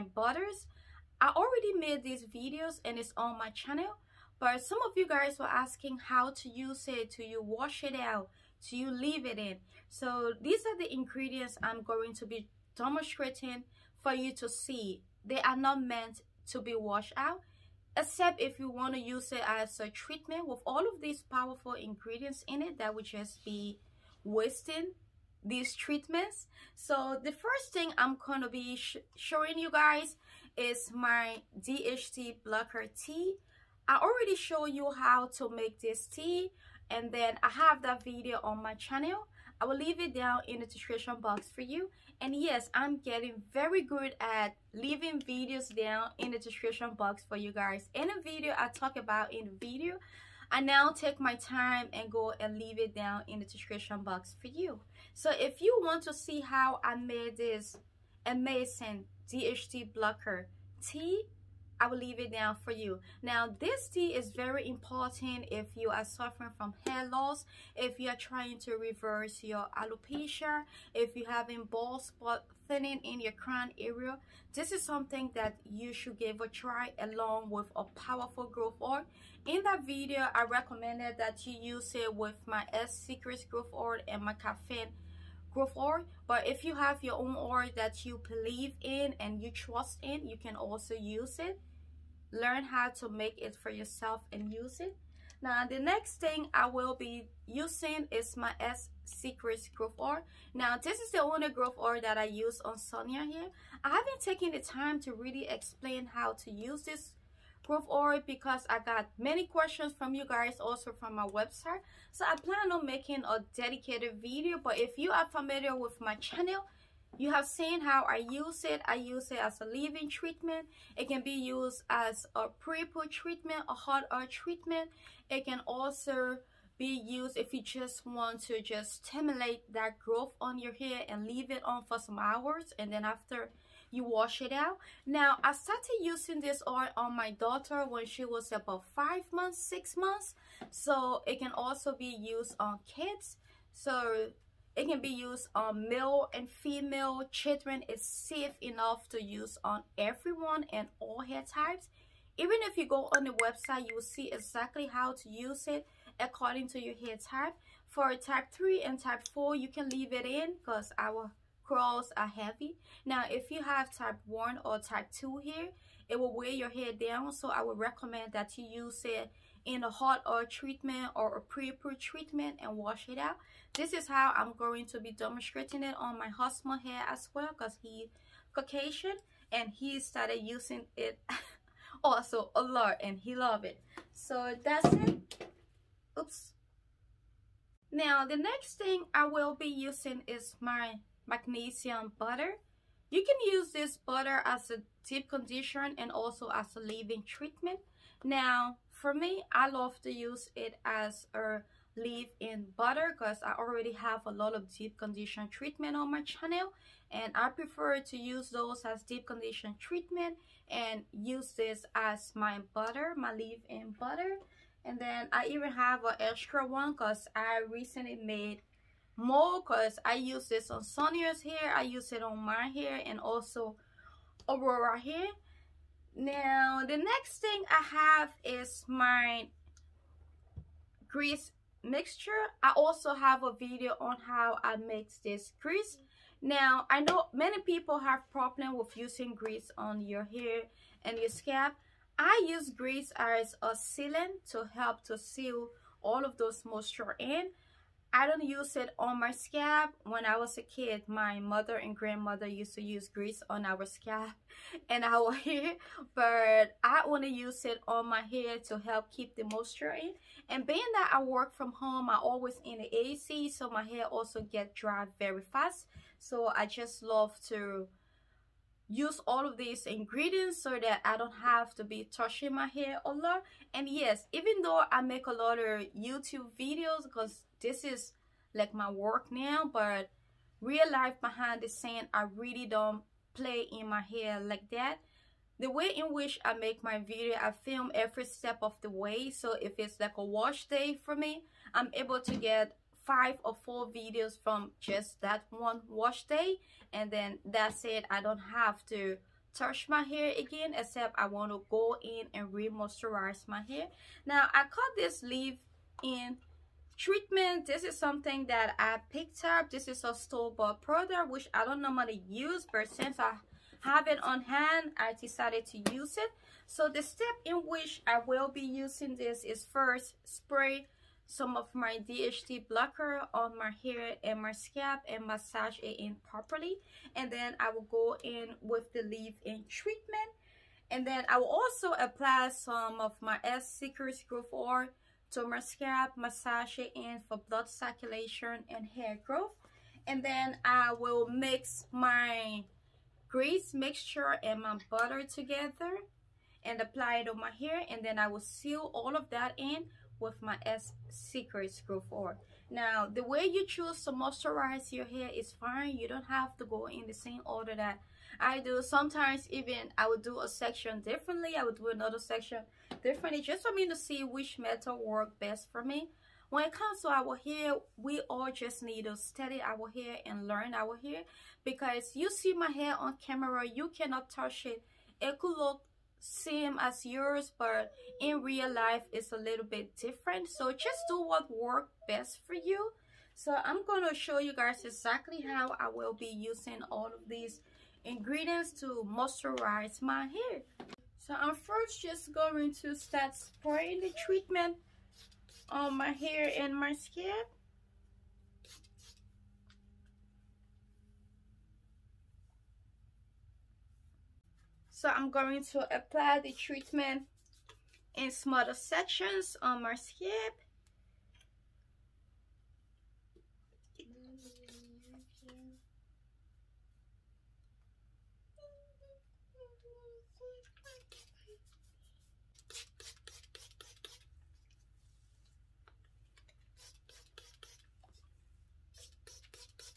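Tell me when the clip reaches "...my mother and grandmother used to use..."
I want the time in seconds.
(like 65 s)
251 s.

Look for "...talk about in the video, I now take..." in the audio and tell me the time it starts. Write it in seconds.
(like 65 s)
48 s.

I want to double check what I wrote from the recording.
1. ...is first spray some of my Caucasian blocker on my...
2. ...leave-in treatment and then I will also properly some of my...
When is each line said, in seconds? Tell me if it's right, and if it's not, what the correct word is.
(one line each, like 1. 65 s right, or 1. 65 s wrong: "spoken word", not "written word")
1. 319 s wrong: "DHT", not "Caucasian"
2. 329 s wrong: "apply", not "properly".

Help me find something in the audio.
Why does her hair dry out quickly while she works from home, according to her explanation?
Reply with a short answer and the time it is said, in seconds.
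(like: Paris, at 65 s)
the AC, at 262 s.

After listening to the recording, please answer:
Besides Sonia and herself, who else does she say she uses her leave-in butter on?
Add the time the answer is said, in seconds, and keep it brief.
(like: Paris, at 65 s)
Aurora, at 224 s.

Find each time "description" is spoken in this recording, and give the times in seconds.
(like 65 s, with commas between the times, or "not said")
40 s, 46 s, 53 s.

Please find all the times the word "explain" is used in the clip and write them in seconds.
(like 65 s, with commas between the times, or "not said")
105 s.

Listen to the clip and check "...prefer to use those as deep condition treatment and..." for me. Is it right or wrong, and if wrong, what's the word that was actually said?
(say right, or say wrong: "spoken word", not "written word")
right.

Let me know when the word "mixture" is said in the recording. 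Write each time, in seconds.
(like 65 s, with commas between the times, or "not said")
231 s, 343 s.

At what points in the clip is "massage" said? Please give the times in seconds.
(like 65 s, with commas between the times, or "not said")
325 s, 336 s.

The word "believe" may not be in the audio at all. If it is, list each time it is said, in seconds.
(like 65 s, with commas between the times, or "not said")
88 s.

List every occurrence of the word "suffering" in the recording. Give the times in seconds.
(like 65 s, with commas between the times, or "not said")
66 s.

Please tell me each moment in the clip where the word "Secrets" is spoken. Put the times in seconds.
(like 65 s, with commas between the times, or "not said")
82 s, 99 s, 333 s, 351 s.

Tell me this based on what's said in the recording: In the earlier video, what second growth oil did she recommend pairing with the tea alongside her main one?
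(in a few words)
caffeine growth oil.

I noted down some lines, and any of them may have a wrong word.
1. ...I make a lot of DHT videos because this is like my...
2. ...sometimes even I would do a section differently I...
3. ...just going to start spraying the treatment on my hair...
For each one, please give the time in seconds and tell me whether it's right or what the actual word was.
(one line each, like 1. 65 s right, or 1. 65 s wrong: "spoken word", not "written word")
1. 274 s wrong: "YouTube", not "DHT"
2. 358 s right
3. 392 s right.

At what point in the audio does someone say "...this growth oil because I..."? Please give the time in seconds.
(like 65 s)
106 s.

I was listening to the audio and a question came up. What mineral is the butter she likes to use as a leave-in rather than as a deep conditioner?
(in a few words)
magnesium.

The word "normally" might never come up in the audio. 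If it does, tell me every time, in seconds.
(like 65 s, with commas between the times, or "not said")
311 s.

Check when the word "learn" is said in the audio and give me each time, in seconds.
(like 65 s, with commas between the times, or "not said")
92 s, 370 s.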